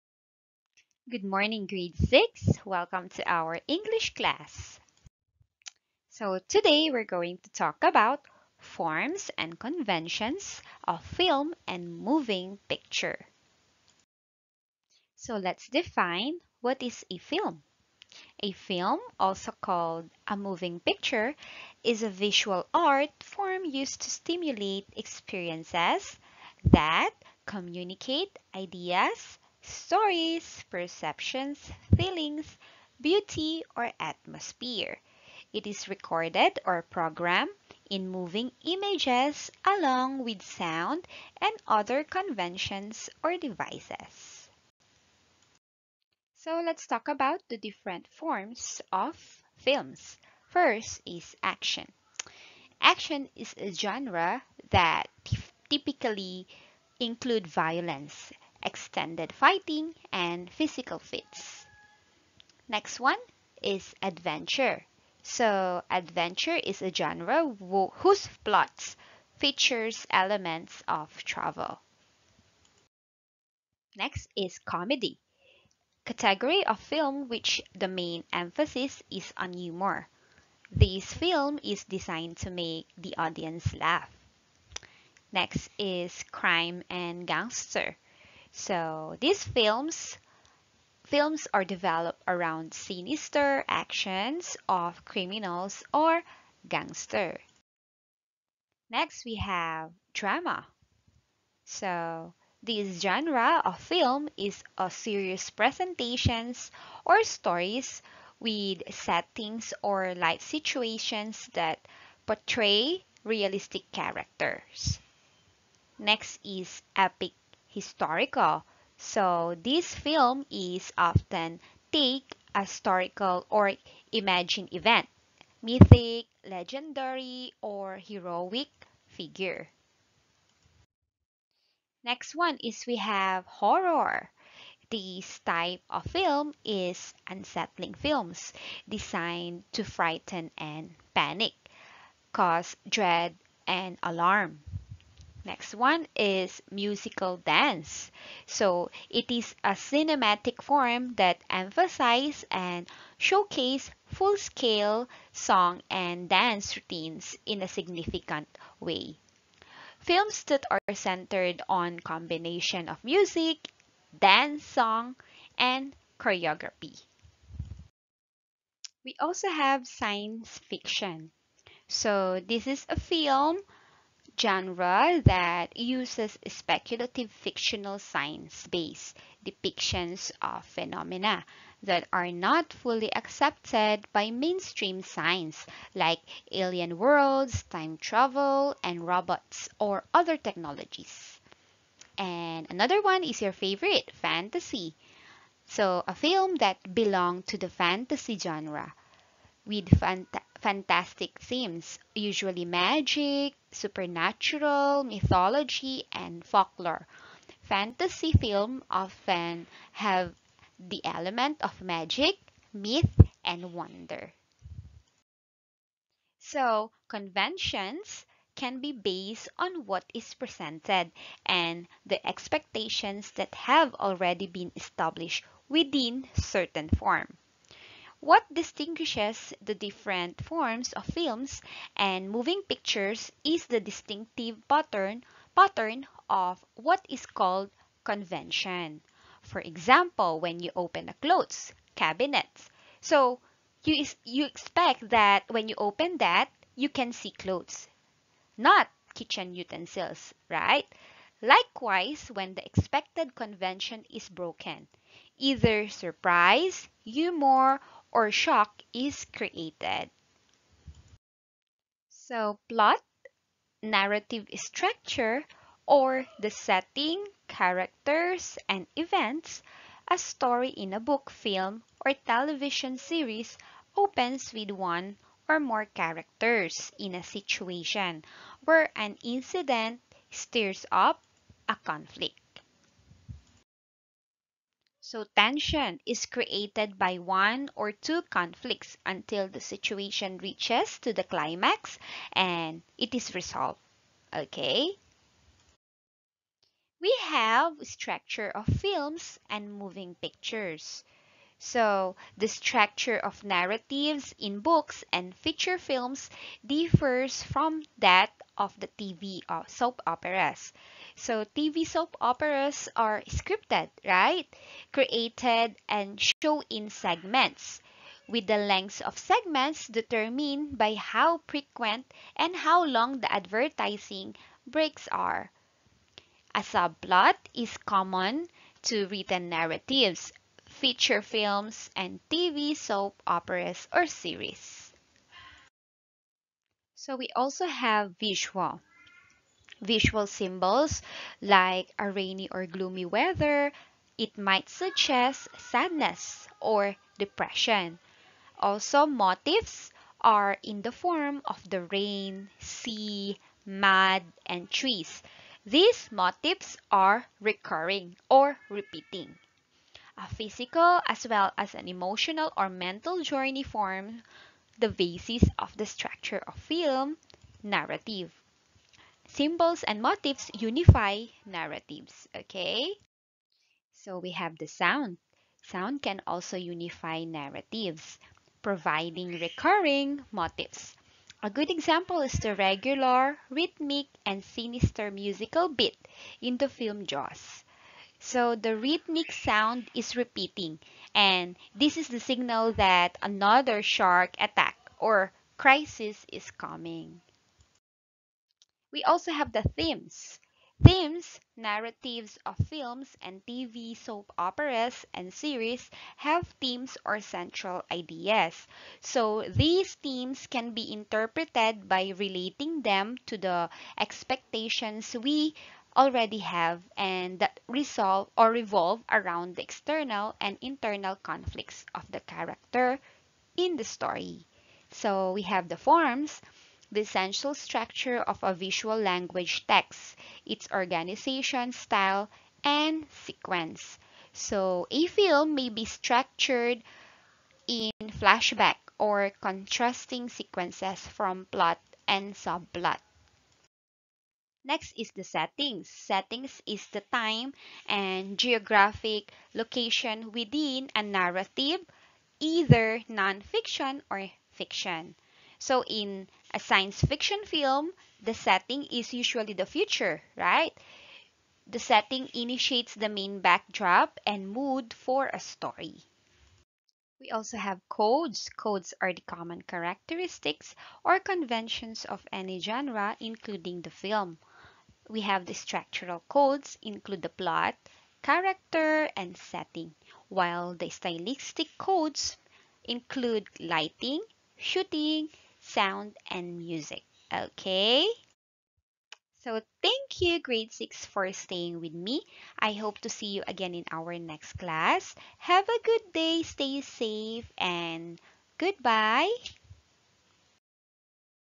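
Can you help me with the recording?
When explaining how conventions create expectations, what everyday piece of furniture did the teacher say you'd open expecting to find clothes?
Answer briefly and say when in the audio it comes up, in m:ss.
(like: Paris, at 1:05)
Clothes cabinet, at 4:01.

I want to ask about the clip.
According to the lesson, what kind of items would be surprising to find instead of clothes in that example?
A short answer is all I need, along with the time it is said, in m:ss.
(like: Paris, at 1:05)
Kitchen utensils, at 4:09.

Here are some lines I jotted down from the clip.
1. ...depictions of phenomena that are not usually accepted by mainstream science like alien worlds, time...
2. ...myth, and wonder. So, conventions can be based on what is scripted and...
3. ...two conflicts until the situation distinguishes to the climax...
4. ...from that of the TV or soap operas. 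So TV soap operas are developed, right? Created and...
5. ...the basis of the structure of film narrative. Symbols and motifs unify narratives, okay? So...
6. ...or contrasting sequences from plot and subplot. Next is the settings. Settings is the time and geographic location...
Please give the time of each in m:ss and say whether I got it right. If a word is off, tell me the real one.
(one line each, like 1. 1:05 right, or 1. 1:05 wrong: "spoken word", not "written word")
1. 2:59 wrong: "fully", not "usually"
2. 3:32 wrong: "presented", not "scripted"
3. 4:47 wrong: "reaches", not "distinguishes"
4. 5:07 wrong: "scripted", not "developed"
5. 6:04 right
6. 7:18 right.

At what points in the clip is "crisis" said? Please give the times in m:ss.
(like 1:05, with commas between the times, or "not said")
6:35.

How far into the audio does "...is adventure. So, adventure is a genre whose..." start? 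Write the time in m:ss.
1:03.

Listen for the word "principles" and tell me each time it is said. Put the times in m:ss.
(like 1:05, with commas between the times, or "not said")
not said.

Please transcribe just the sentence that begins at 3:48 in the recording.
What distinguishes the different forms of films and moving pictures is the distinctive pattern, pattern of what is called convention.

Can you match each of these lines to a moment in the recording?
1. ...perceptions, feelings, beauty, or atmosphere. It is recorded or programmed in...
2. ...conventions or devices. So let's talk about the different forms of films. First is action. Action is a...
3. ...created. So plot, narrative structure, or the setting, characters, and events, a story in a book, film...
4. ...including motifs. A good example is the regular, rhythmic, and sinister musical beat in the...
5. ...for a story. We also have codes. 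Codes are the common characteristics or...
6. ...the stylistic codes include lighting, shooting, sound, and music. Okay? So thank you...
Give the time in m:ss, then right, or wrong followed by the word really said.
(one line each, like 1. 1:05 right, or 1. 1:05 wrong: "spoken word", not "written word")
1. 0:30 right
2. 0:42 right
3. 4:19 right
4. 6:19 wrong: "recurring", not "including"
5. 7:44 right
6. 8:00 right.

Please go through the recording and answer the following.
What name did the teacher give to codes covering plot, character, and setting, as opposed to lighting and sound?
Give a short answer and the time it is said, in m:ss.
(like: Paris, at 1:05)
Structural codes, at 7:55.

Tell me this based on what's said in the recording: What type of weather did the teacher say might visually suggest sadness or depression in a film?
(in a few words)
Rainy or gloomy.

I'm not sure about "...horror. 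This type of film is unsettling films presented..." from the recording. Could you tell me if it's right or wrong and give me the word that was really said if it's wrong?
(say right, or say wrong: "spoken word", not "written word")
wrong: "designed", not "presented".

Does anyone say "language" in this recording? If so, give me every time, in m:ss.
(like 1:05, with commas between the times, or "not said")
7:08.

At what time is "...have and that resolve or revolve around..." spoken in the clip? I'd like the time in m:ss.
6:56.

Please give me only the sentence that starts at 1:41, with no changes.
So this genre of film is a serious presentations or stories with settings or life situations that portray realistic characters.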